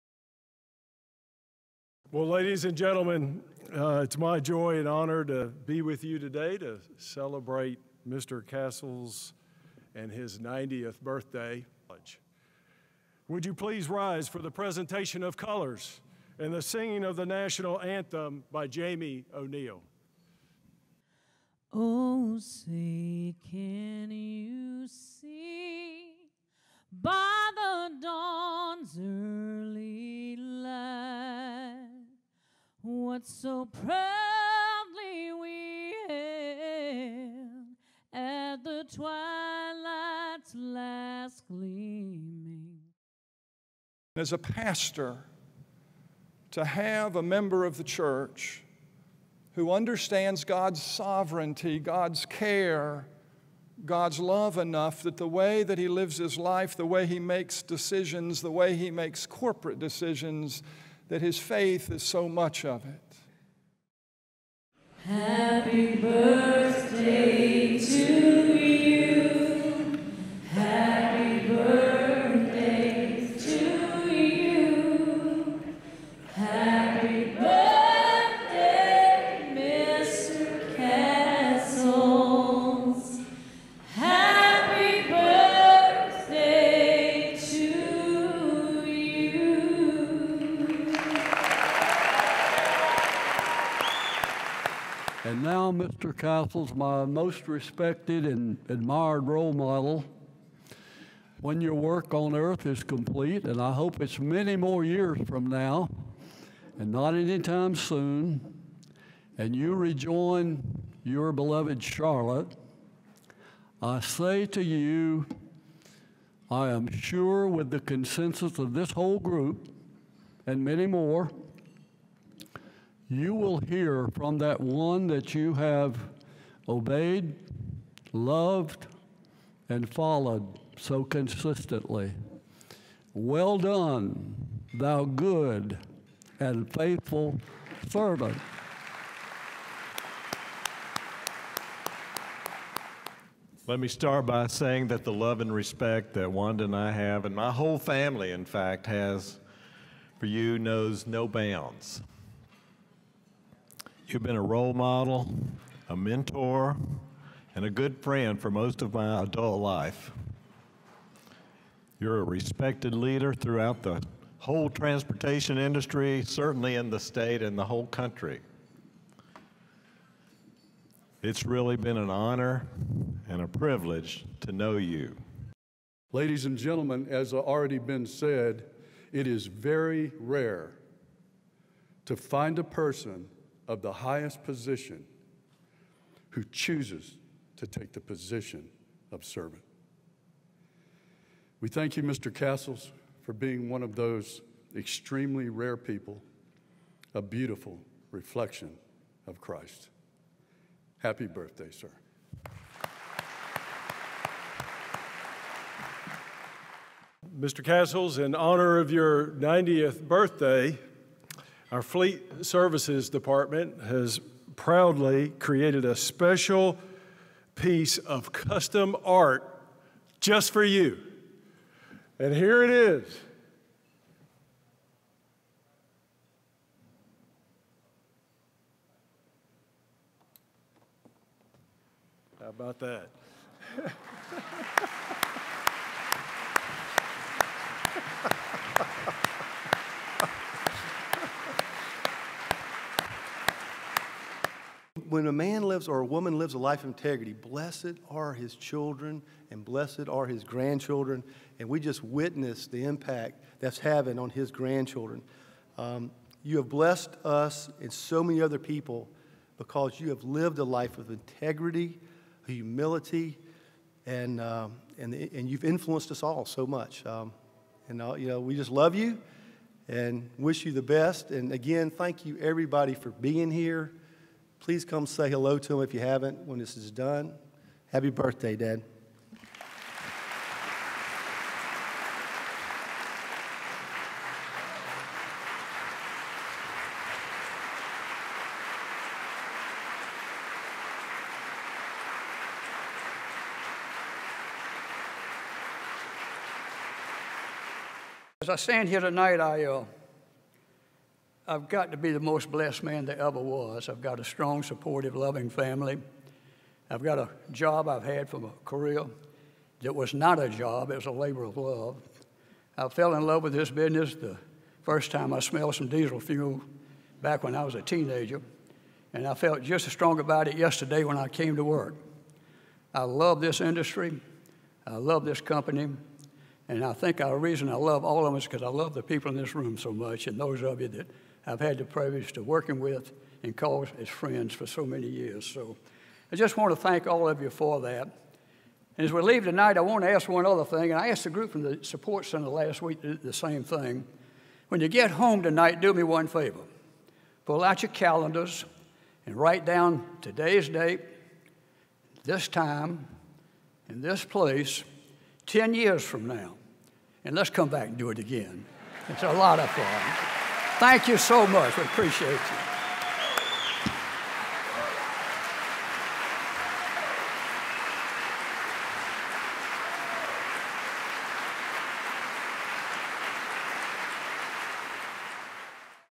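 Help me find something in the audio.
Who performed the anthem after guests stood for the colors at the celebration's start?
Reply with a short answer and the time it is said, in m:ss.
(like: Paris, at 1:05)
Jamie O'Neill, at 0:18.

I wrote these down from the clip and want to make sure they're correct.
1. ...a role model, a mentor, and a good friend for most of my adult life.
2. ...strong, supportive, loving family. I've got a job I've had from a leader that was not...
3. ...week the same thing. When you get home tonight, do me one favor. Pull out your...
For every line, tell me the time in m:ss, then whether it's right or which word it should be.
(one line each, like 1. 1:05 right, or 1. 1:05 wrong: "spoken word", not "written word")
1. 2:34 right
2. 5:04 wrong: "career", not "leader"
3. 5:42 right.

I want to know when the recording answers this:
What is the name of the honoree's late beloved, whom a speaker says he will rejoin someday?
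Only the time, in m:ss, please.
1:51.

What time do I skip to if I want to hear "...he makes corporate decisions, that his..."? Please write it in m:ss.
0:58.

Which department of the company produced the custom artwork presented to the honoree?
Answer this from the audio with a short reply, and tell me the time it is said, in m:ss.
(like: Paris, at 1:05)
Fleet Services, at 3:31.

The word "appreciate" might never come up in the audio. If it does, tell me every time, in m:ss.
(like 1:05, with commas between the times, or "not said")
6:01.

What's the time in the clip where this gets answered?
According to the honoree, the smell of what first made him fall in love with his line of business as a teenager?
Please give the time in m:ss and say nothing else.
5:15.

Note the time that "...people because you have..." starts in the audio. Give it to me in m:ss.
4:18.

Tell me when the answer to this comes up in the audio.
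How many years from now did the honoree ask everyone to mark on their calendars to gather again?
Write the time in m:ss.
5:55.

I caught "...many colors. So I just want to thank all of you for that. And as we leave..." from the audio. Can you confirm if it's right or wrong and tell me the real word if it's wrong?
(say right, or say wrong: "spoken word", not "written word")
wrong: "years", not "colors".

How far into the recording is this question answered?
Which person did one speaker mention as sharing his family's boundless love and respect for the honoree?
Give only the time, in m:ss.
2:26.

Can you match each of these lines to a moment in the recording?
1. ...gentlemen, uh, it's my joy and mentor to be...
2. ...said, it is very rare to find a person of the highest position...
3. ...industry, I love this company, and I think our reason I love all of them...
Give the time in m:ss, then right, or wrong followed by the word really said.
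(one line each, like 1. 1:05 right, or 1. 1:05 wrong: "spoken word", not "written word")
1. 0:02 wrong: "honor", not "mentor"
2. 2:58 right
3. 5:23 right.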